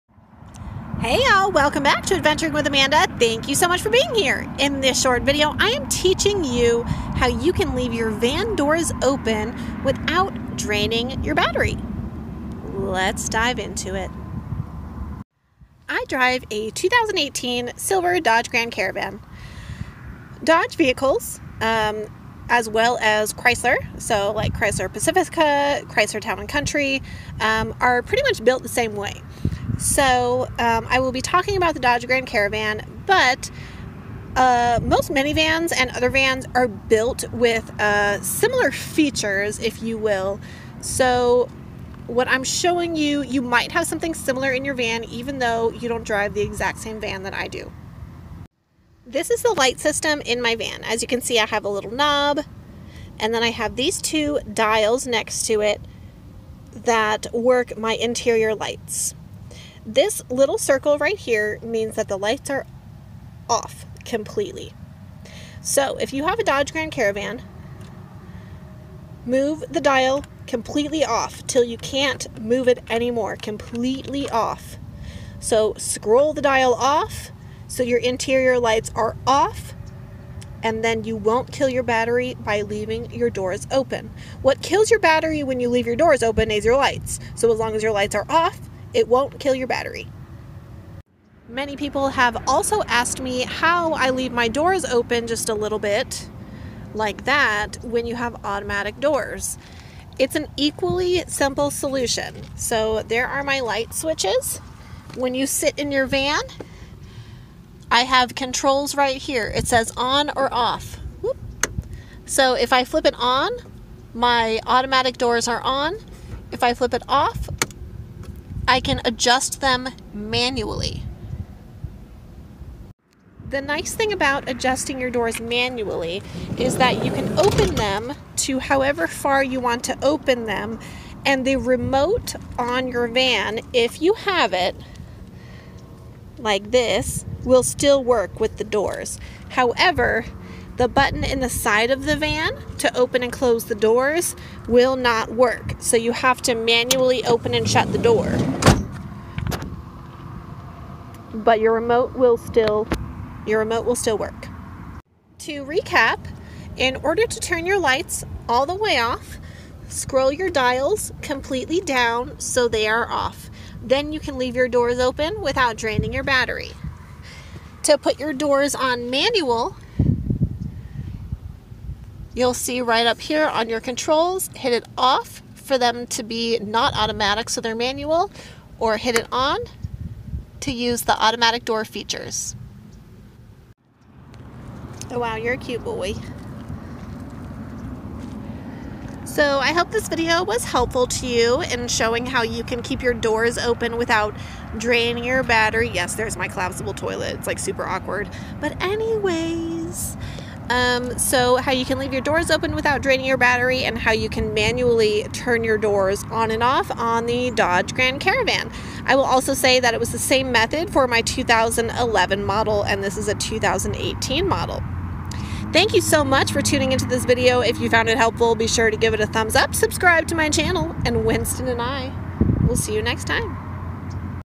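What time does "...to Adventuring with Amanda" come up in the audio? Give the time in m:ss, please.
0:02.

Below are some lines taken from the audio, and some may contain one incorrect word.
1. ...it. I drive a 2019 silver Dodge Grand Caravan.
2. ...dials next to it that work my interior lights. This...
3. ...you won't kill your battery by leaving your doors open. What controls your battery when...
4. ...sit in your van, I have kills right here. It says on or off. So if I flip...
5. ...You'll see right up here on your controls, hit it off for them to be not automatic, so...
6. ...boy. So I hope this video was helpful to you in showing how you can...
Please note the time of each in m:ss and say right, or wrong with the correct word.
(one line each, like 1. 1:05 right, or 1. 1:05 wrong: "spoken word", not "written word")
1. 0:13 wrong: "2018", not "2019"
2. 0:54 right
3. 1:21 wrong: "kills", not "controls"
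4. 1:45 wrong: "controls", not "kills"
5. 2:52 right
6. 3:05 right.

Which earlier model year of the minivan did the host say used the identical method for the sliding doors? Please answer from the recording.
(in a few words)
2011.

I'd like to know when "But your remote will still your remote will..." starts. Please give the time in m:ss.
2:31.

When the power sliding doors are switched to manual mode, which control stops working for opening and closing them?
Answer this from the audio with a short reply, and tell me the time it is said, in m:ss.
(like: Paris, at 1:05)
The button in the side of the van, at 2:20.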